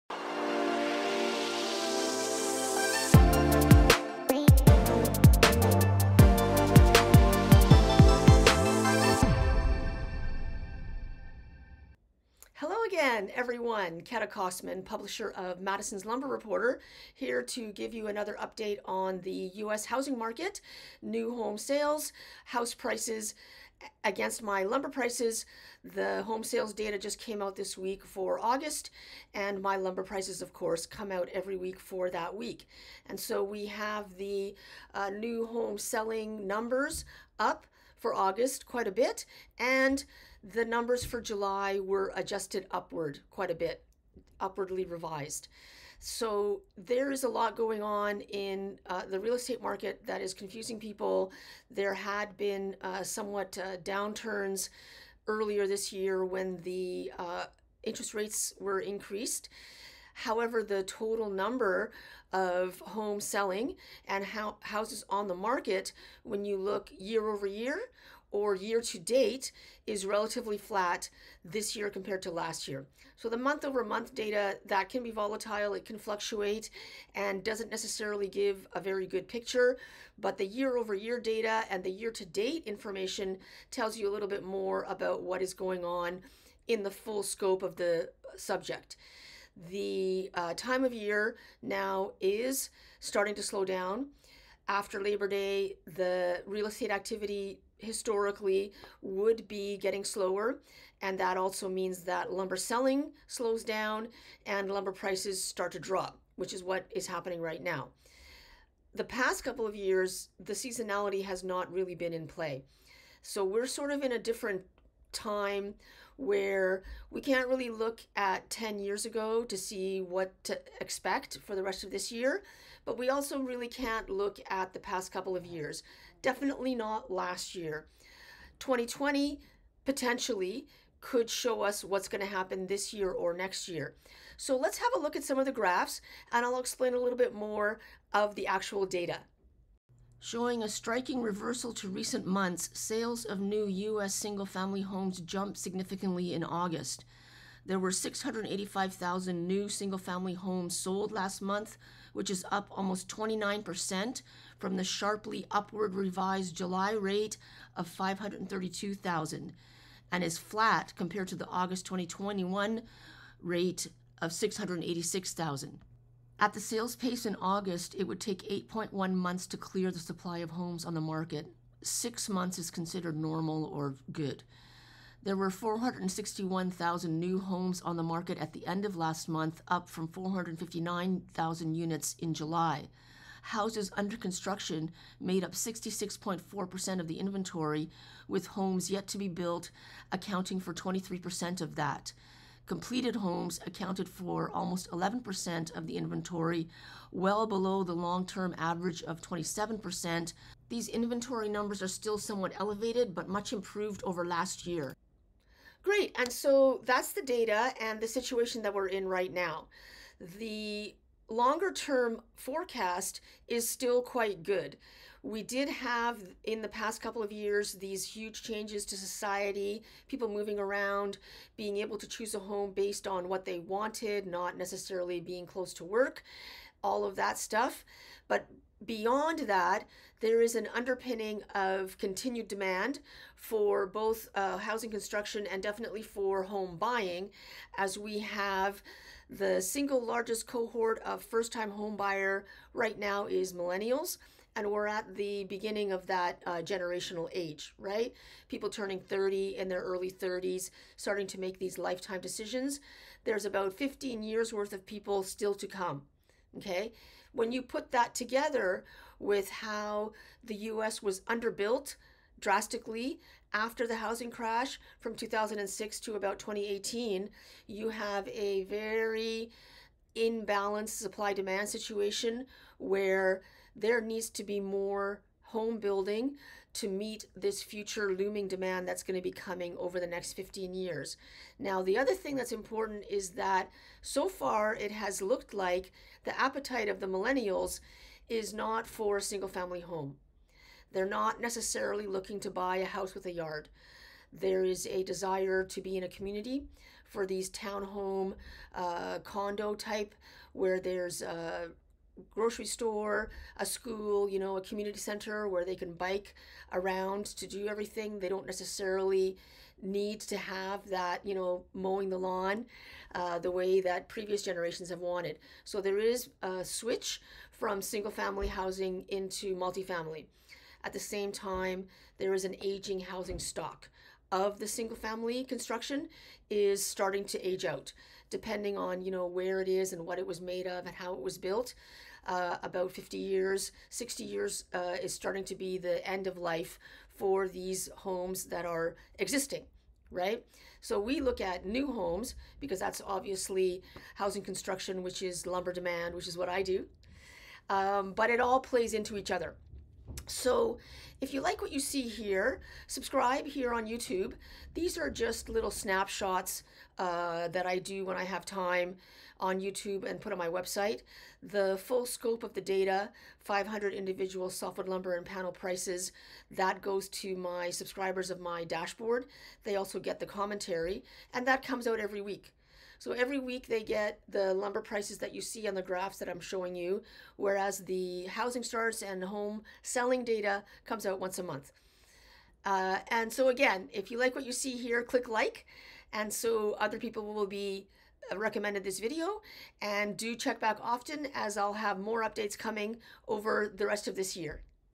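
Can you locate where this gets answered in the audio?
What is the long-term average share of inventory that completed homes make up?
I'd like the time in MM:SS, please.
03:19.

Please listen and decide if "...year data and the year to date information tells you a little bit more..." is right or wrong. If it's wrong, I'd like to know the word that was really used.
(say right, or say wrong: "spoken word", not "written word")
right.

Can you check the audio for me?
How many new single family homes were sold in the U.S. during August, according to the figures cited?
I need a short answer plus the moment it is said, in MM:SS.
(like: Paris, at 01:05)
685,000, at 02:27.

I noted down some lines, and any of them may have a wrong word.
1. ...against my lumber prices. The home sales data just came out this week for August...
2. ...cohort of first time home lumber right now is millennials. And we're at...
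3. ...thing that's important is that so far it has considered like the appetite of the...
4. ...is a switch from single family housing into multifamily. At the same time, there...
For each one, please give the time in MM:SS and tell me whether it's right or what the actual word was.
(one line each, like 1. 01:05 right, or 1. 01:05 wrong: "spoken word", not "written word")
1. 00:24 right
2. 04:00 wrong: "buyer", not "lumber"
3. 04:42 wrong: "looked", not "considered"
4. 05:15 right.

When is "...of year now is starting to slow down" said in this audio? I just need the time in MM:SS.
01:30.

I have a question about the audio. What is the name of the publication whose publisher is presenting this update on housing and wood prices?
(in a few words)
Madison's Lumber Reporter.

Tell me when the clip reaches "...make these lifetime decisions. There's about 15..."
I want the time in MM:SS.
04:11.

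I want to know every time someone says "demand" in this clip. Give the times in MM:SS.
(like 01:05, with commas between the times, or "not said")
03:52, 04:31, 04:38, 05:45.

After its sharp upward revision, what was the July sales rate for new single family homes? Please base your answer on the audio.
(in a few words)
532,000.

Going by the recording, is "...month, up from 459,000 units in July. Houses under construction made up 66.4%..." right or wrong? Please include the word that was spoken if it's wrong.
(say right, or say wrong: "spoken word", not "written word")
right.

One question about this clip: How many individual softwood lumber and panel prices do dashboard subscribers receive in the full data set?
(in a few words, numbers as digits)
500.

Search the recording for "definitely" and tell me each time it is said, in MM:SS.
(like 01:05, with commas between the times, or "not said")
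02:06, 03:55.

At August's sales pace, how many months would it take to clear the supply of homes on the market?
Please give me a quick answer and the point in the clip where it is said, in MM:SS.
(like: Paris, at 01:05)
8.1 months, at 02:48.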